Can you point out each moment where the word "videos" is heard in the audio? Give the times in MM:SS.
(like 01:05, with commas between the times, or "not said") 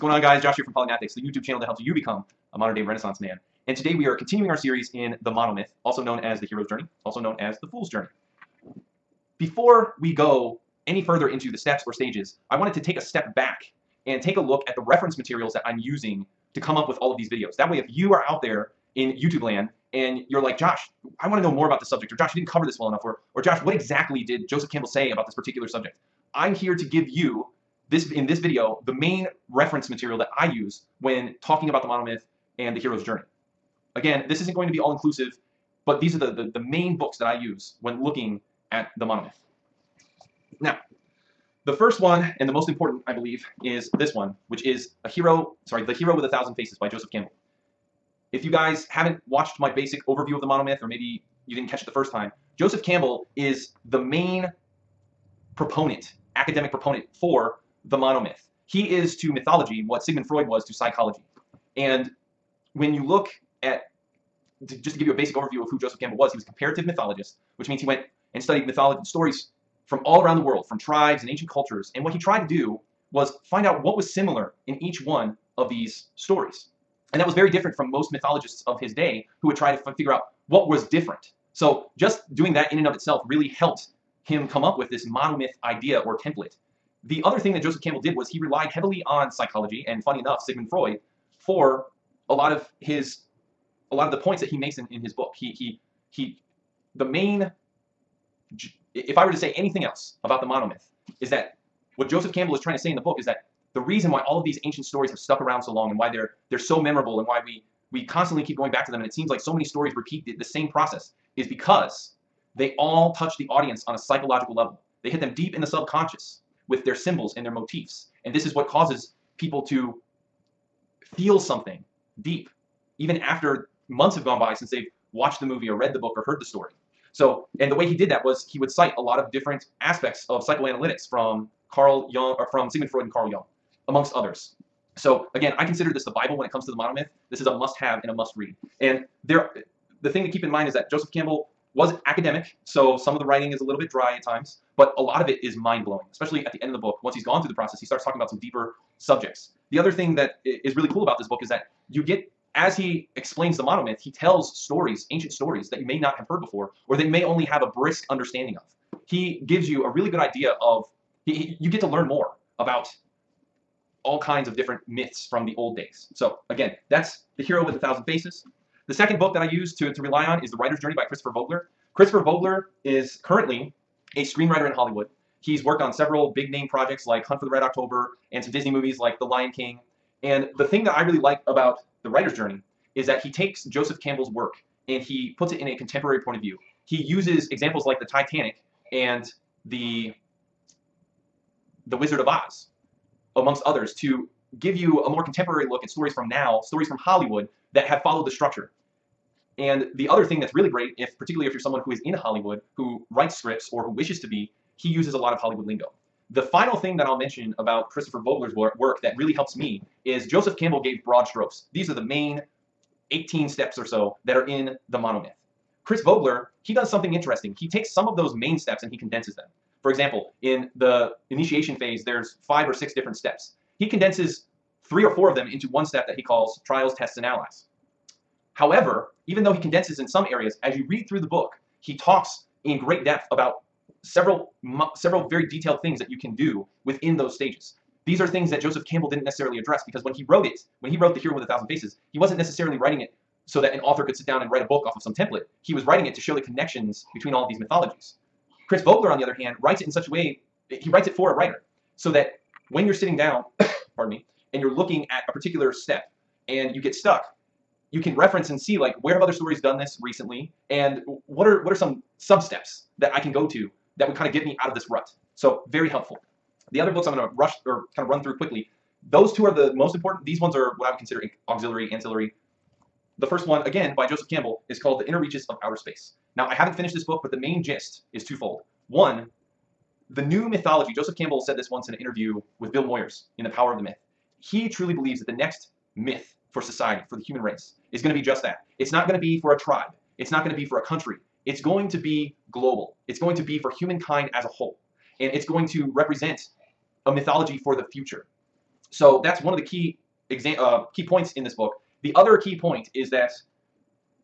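00:17, 00:28.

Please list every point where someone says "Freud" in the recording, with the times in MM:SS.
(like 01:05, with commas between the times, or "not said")
01:00, 01:30, 02:12.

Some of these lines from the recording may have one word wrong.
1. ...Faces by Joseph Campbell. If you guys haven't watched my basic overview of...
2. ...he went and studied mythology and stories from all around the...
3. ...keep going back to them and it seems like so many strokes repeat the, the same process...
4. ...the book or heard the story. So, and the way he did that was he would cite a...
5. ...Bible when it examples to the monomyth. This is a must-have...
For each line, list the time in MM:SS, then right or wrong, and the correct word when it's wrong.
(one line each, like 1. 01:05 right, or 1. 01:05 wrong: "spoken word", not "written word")
1. 00:46 right
2. 01:07 right
3. 01:48 wrong: "stories", not "strokes"
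4. 02:05 right
5. 02:16 wrong: "comes", not "examples".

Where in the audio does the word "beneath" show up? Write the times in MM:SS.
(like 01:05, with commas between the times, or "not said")
not said.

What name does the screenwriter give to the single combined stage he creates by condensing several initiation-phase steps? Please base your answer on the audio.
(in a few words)
Trials, tests, and allies.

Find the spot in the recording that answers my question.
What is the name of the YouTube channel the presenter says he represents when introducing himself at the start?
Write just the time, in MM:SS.
00:00.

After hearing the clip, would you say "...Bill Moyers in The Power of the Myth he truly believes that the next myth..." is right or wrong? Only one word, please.
right.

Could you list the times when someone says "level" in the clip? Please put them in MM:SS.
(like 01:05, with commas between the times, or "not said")
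01:54.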